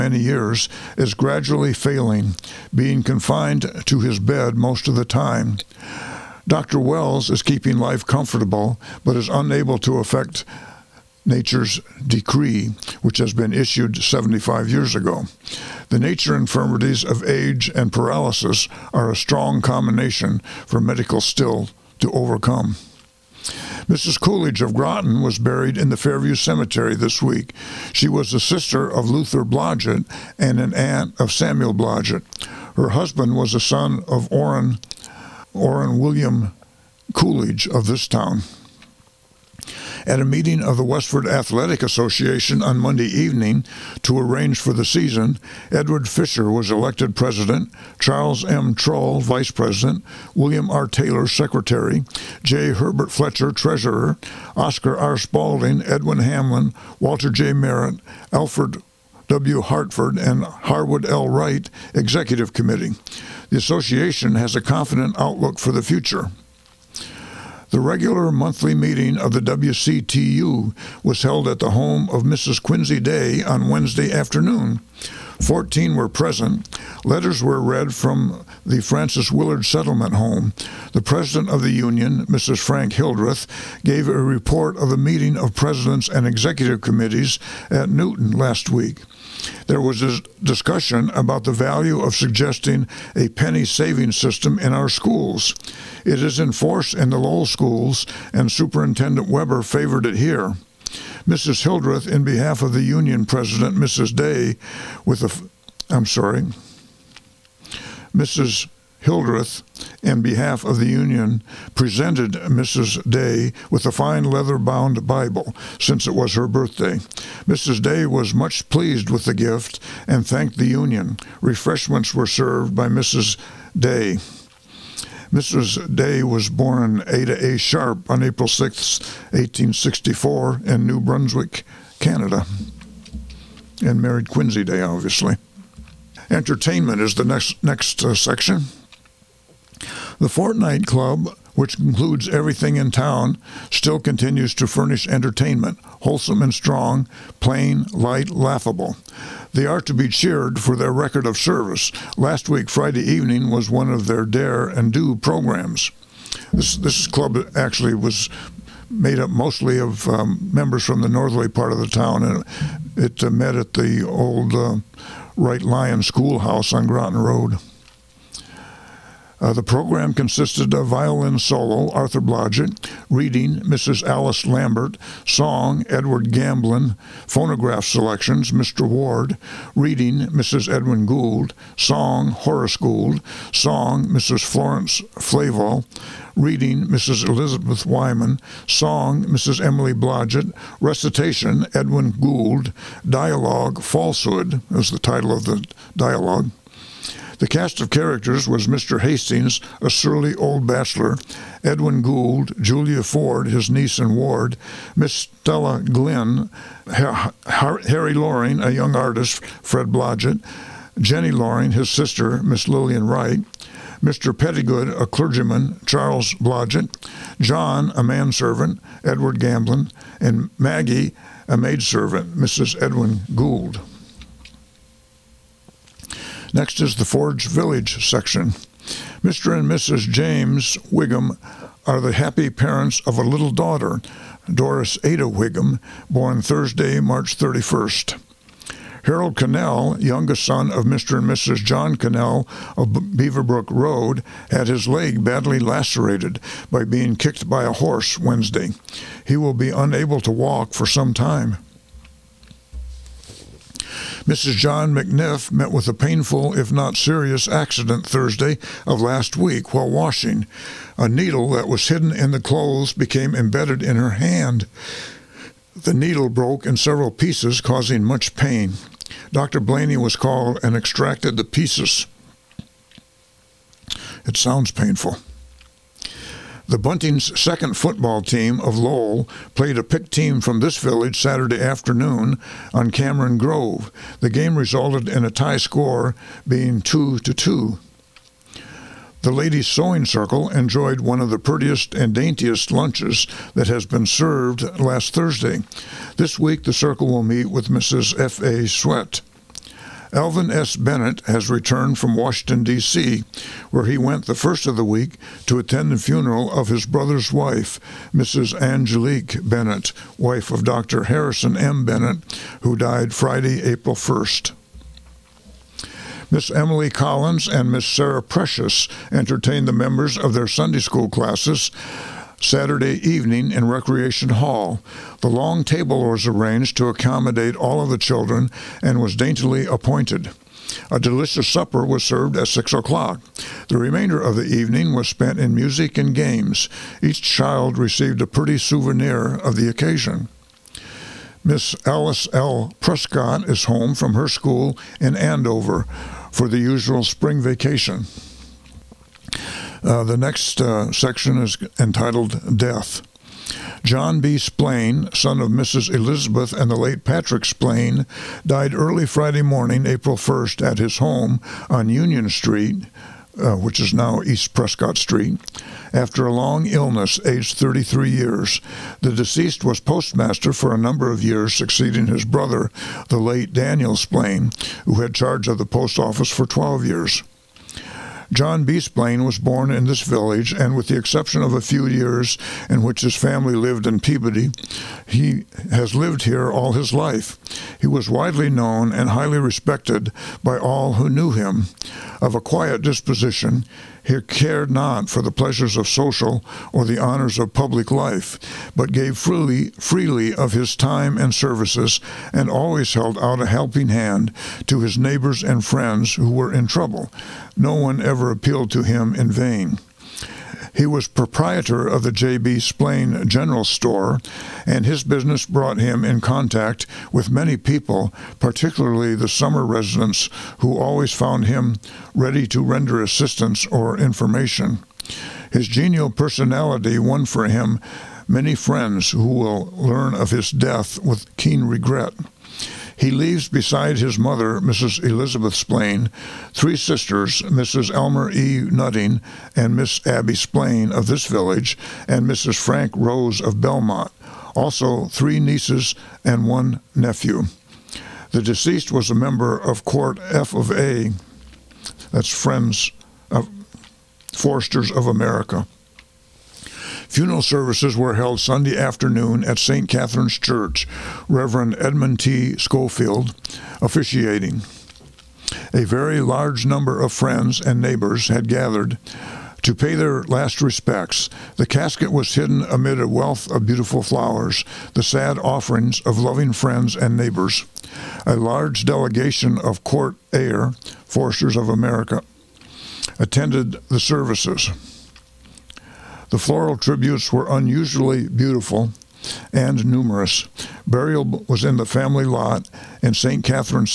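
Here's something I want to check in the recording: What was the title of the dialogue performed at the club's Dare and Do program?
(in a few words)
Falsehood.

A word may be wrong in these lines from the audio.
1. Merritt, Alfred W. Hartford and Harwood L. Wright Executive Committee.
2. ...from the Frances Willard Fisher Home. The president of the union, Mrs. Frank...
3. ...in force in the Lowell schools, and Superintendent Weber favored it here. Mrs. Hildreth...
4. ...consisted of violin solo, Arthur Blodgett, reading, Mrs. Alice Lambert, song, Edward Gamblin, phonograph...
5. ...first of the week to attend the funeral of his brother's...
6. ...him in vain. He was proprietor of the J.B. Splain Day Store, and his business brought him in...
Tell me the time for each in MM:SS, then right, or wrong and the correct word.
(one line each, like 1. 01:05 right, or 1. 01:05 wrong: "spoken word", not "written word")
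1. 00:57 right
2. 01:17 wrong: "Settlement", not "Fisher"
3. 01:36 right
4. 02:50 right
5. 05:04 right
6. 06:48 wrong: "General", not "Day".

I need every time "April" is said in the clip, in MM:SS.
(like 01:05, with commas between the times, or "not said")
02:08, 05:13, 05:59.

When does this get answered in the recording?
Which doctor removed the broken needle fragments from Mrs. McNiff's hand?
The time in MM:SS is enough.
04:29.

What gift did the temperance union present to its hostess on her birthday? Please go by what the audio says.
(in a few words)
leather bound Bible.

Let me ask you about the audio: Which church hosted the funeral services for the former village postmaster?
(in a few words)
St. Catherine's Church.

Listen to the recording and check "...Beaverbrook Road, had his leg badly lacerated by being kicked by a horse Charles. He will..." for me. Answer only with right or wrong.
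wrong.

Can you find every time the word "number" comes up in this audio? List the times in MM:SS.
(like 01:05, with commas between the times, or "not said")
06:10, 07:46.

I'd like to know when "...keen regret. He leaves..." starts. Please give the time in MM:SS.
07:11.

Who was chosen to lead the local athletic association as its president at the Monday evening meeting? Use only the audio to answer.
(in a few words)
Edward Fisher.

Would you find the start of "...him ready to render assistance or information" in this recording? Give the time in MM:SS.
07:01.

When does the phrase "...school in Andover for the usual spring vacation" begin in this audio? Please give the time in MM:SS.
05:44.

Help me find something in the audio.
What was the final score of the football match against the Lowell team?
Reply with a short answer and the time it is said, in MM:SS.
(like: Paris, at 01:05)
2 to 2, at 04:46.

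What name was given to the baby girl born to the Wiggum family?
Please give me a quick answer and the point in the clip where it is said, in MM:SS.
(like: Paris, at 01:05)
Doris Ada Wiggum, at 03:54.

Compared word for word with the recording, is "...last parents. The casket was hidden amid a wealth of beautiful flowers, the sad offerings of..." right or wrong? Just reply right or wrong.
wrong.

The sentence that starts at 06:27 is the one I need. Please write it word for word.
He was widely known and highly respected by all who knew him.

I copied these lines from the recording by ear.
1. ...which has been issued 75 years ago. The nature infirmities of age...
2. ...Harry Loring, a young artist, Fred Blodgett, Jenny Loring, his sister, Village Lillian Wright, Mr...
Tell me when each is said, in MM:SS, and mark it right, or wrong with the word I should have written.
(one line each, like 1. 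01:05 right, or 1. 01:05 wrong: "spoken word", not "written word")
1. 00:13 right
2. 03:26 wrong: "Miss", not "Village".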